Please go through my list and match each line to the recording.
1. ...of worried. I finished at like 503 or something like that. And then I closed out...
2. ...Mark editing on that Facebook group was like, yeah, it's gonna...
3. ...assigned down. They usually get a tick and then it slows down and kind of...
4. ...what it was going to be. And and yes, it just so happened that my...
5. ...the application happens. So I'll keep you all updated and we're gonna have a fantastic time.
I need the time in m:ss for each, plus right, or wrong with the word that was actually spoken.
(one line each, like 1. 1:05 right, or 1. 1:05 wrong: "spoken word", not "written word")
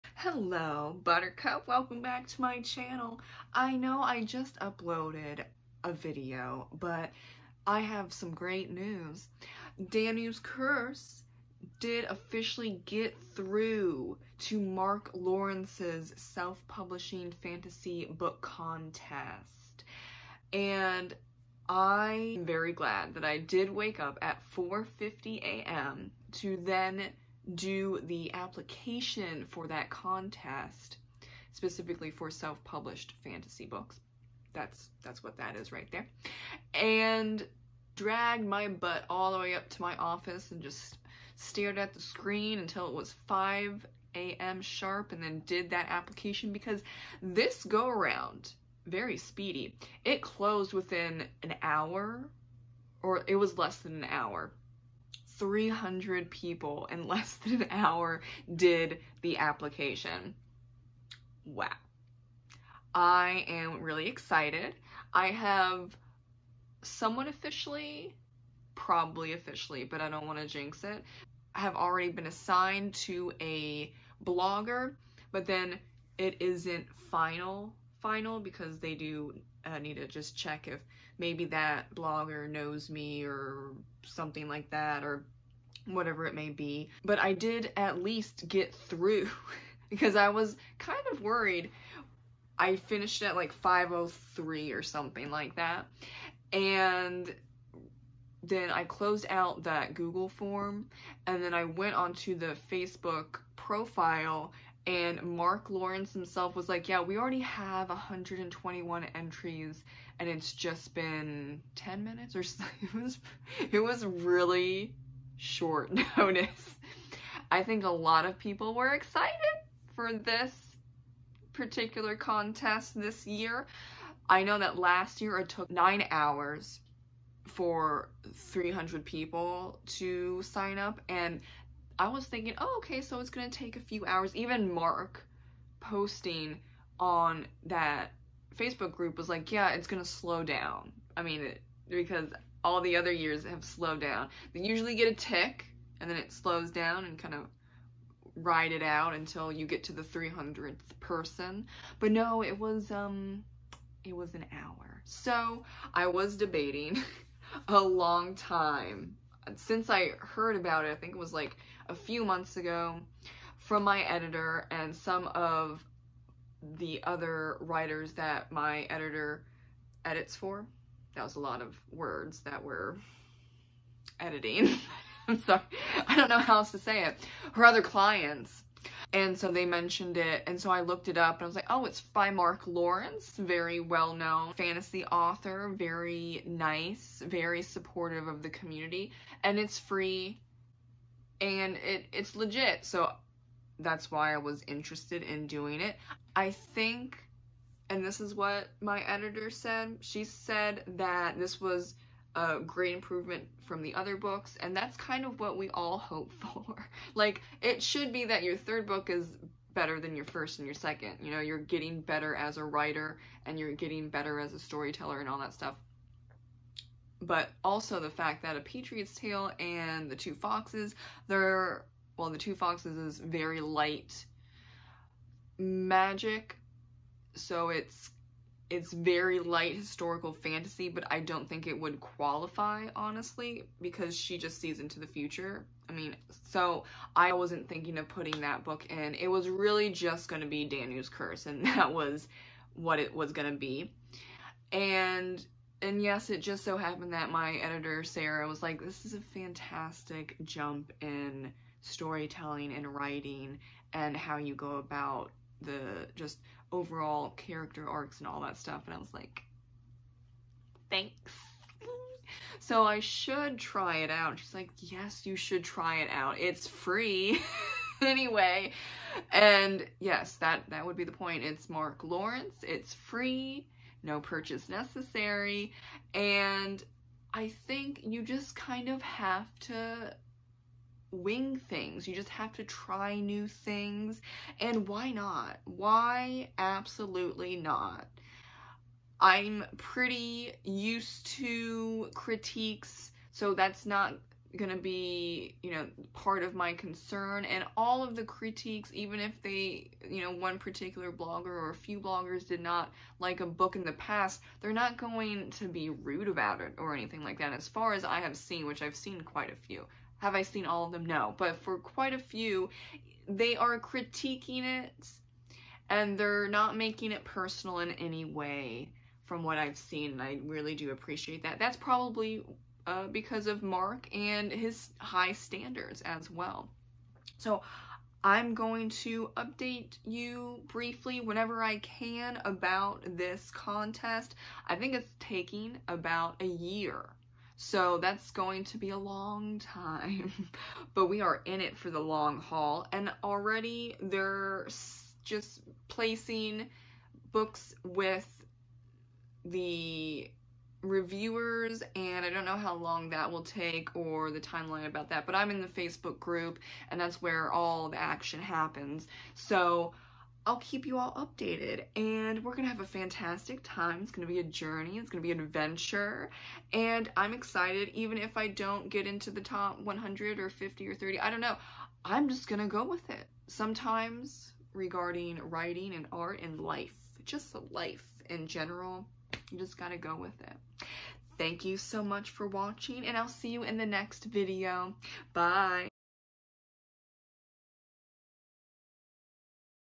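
1. 1:31 right
2. 2:14 wrong: "posting", not "editing"
3. 2:23 wrong: "slowed", not "assigned"
4. 4:02 right
5. 5:57 wrong: "action", not "application".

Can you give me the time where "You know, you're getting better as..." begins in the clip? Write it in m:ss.
3:31.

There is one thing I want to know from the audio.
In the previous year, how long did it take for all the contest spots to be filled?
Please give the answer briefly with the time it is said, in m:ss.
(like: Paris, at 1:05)
9 hours, at 2:05.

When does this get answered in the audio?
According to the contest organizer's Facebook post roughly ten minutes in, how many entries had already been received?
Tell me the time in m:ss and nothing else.
1:47.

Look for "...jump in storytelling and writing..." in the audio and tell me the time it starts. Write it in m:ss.
4:10.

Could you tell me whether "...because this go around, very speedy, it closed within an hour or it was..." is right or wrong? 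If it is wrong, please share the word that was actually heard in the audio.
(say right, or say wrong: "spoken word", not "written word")
right.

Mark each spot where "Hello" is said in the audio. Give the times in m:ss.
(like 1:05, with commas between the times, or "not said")
0:00.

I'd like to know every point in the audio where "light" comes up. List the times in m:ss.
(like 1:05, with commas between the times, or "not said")
3:43, 3:49.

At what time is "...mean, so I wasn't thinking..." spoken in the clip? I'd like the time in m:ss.
3:55.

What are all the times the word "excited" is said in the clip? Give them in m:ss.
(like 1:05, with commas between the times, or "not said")
1:04, 1:58, 6:07.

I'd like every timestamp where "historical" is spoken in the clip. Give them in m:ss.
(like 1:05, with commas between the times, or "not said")
3:49.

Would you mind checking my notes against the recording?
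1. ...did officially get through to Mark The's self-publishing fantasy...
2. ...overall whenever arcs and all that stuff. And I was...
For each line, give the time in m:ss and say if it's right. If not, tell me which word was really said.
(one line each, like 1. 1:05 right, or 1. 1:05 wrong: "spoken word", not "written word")
1. 0:11 wrong: "Lawrence", not "The"
2. 4:16 wrong: "character", not "whenever".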